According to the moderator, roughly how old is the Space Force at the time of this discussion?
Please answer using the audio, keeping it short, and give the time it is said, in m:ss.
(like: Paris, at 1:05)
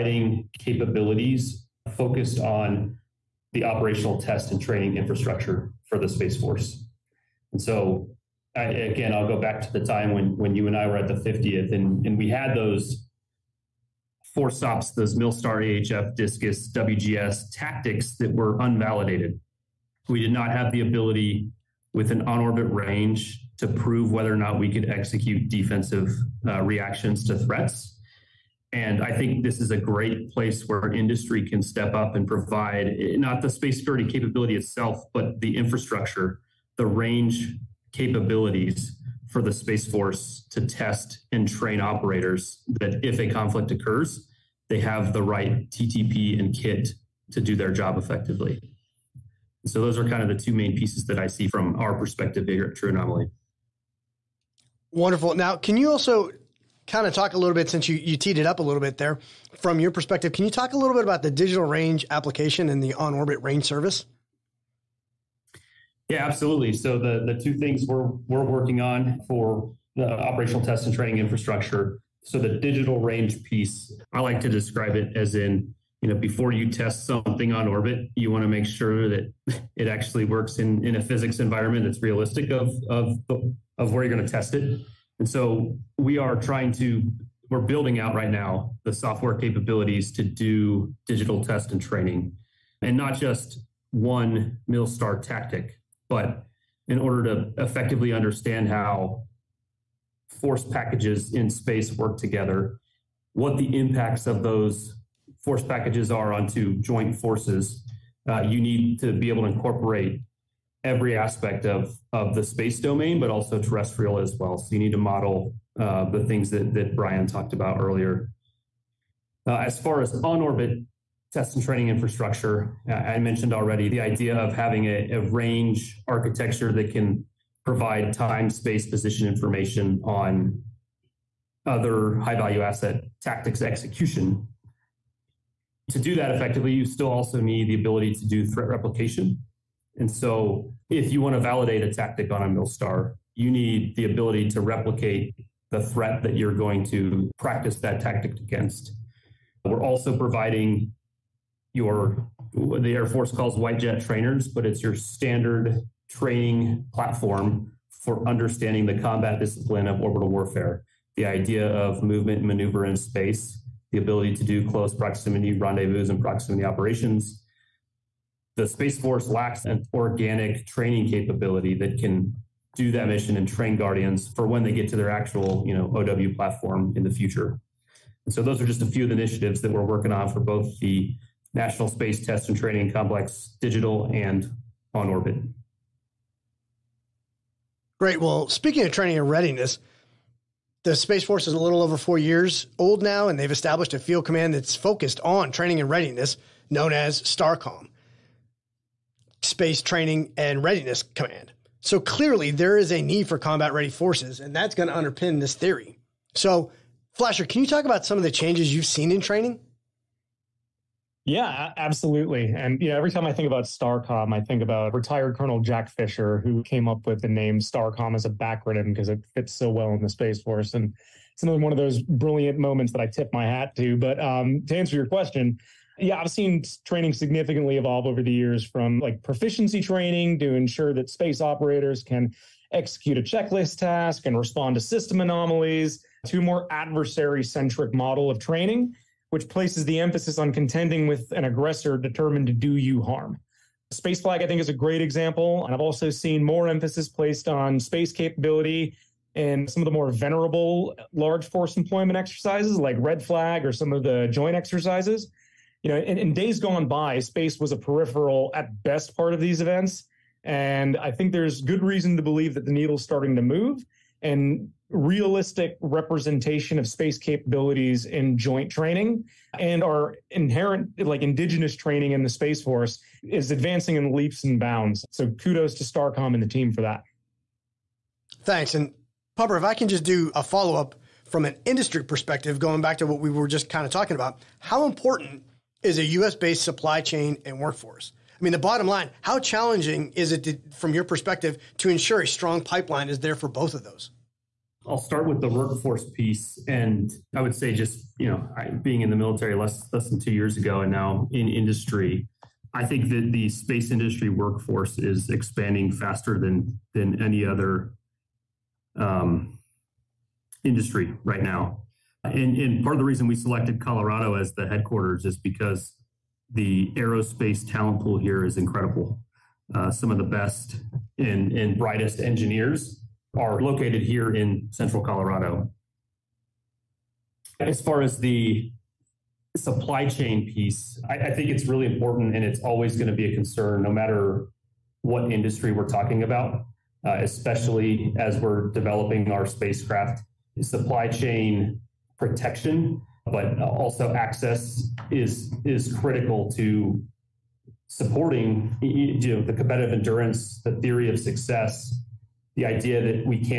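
a little over 4 years, at 3:11.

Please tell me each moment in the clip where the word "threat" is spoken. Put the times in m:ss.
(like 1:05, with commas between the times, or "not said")
0:27, 2:18, 2:25.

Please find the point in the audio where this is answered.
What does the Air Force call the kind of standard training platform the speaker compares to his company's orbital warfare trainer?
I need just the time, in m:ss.
2:33.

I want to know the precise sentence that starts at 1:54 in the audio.
So you need to model uh, the things that, that Brian talked about earlier.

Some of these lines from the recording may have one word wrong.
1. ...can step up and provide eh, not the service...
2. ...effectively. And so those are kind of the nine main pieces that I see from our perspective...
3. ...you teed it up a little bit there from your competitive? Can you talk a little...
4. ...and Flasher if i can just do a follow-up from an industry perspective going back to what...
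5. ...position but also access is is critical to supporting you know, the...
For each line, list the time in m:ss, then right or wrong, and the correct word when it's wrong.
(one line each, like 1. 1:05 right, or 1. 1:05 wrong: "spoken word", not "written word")
1. 0:31 wrong: "space", not "service"
2. 0:47 wrong: "two", not "nine"
3. 0:57 wrong: "perspective", not "competitive"
4. 4:38 wrong: "Pumper", not "Flasher"
5. 5:42 wrong: "protection", not "position".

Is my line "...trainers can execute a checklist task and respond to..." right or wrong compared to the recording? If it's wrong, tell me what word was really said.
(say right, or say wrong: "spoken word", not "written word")
wrong: "operators", not "trainers".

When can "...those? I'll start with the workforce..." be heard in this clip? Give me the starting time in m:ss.
4:53.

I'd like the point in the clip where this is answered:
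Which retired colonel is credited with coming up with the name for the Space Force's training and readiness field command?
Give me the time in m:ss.
3:35.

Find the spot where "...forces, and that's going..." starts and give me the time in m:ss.
3:23.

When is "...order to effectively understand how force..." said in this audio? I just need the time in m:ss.
1:36.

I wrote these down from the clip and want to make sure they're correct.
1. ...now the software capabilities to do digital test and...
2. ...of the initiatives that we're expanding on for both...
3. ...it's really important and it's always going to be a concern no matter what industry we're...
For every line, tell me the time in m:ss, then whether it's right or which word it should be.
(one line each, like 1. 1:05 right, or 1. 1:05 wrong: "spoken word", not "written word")
1. 1:28 right
2. 2:59 wrong: "working", not "expanding"
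3. 5:31 right.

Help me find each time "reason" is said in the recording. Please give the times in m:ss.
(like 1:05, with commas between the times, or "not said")
4:21, 5:13.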